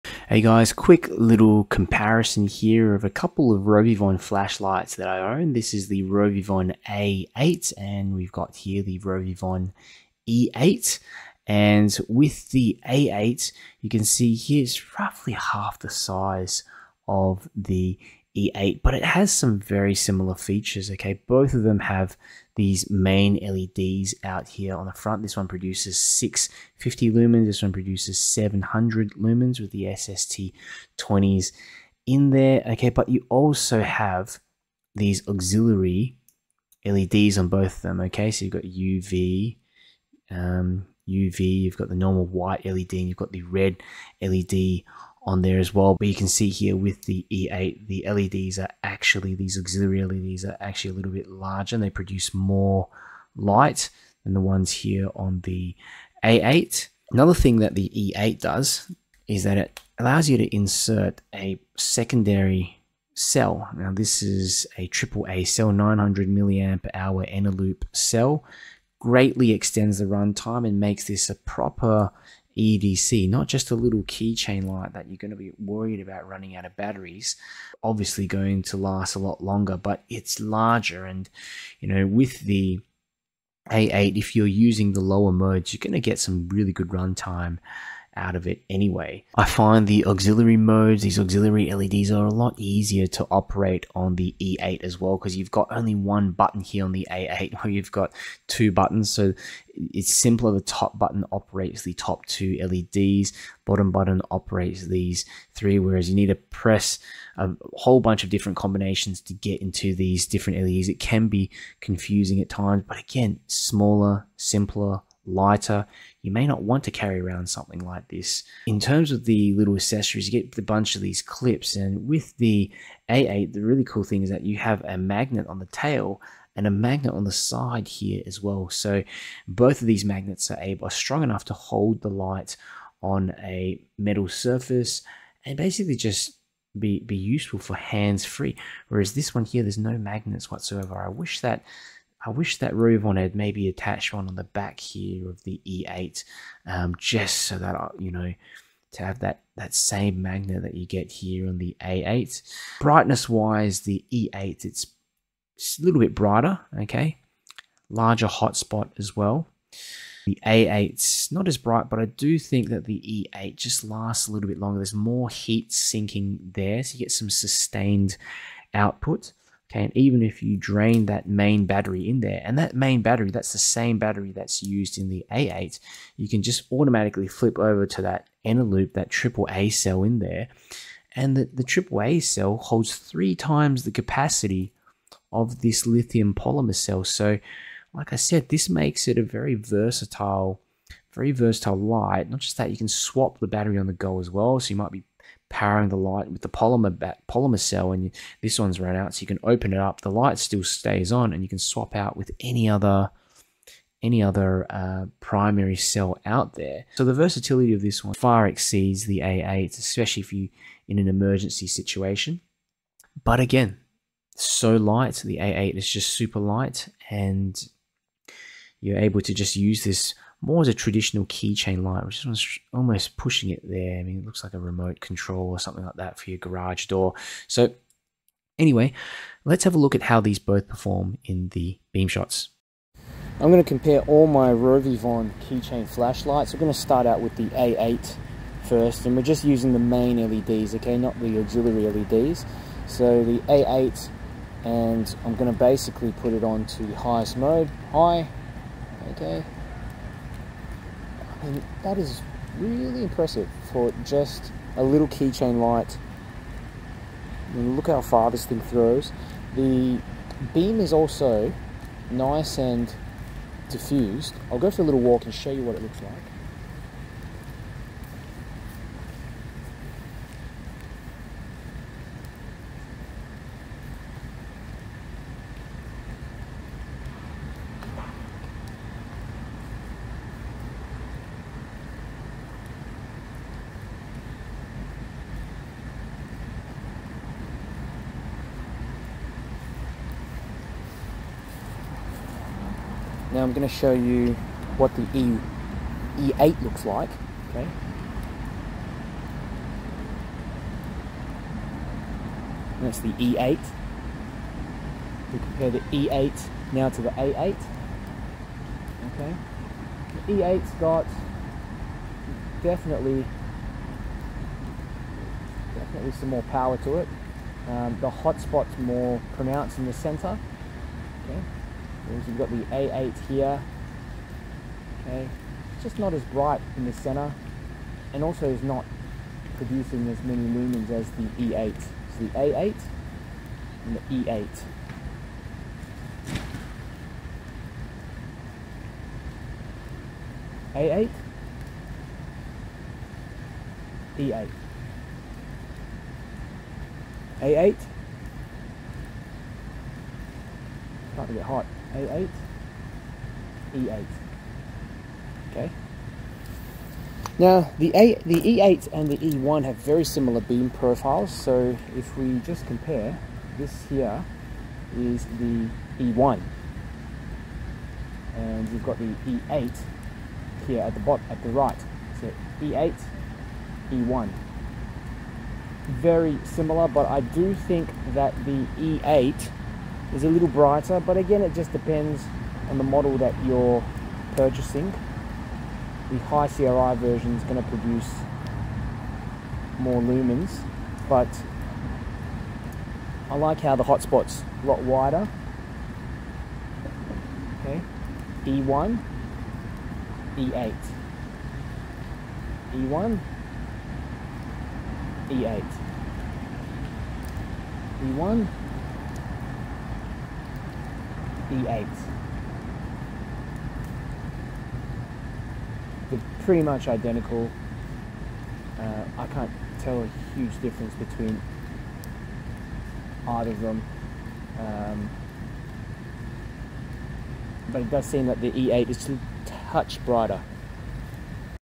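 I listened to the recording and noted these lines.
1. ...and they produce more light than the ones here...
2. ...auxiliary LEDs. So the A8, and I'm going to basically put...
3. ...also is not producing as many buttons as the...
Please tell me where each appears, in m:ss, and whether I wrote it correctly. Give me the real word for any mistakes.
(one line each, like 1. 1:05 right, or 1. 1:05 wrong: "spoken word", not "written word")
1. 0:51 right
2. 4:01 right
3. 5:28 wrong: "lumens", not "buttons".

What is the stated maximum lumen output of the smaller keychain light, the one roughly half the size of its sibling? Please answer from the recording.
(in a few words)
650 lumens.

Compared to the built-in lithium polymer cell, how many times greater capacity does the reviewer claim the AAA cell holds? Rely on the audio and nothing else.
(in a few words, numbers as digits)
Three times.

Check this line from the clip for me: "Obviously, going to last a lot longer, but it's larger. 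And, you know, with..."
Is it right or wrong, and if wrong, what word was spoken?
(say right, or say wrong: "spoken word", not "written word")
right.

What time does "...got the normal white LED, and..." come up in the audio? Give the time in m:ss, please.
0:41.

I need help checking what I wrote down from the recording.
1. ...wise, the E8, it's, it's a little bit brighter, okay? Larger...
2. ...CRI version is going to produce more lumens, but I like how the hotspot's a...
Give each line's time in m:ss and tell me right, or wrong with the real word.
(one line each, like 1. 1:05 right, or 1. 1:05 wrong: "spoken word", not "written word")
1. 2:33 right
2. 6:26 right.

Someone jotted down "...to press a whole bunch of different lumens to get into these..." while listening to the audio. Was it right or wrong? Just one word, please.
wrong.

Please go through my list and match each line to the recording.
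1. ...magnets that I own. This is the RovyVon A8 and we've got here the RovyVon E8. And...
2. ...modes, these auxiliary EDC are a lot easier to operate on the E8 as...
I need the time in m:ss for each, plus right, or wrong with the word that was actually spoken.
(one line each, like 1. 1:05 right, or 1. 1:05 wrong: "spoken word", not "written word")
1. 0:04 wrong: "flashlights", not "magnets"
2. 1:30 wrong: "LEDs", not "EDC".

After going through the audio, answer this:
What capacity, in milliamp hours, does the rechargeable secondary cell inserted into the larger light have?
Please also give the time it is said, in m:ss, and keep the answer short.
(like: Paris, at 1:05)
900 milliamp hour, at 1:05.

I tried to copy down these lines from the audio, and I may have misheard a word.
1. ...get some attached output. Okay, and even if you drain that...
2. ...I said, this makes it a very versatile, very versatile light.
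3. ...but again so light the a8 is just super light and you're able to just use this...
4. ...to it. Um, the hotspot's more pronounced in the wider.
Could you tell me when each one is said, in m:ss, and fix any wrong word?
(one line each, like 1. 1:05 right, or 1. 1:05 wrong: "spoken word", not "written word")
1. 2:46 wrong: "sustained", not "attached"
2. 3:08 right
3. 3:33 right
4. 5:16 wrong: "center", not "wider".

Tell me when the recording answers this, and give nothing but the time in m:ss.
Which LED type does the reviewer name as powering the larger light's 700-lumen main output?
0:29.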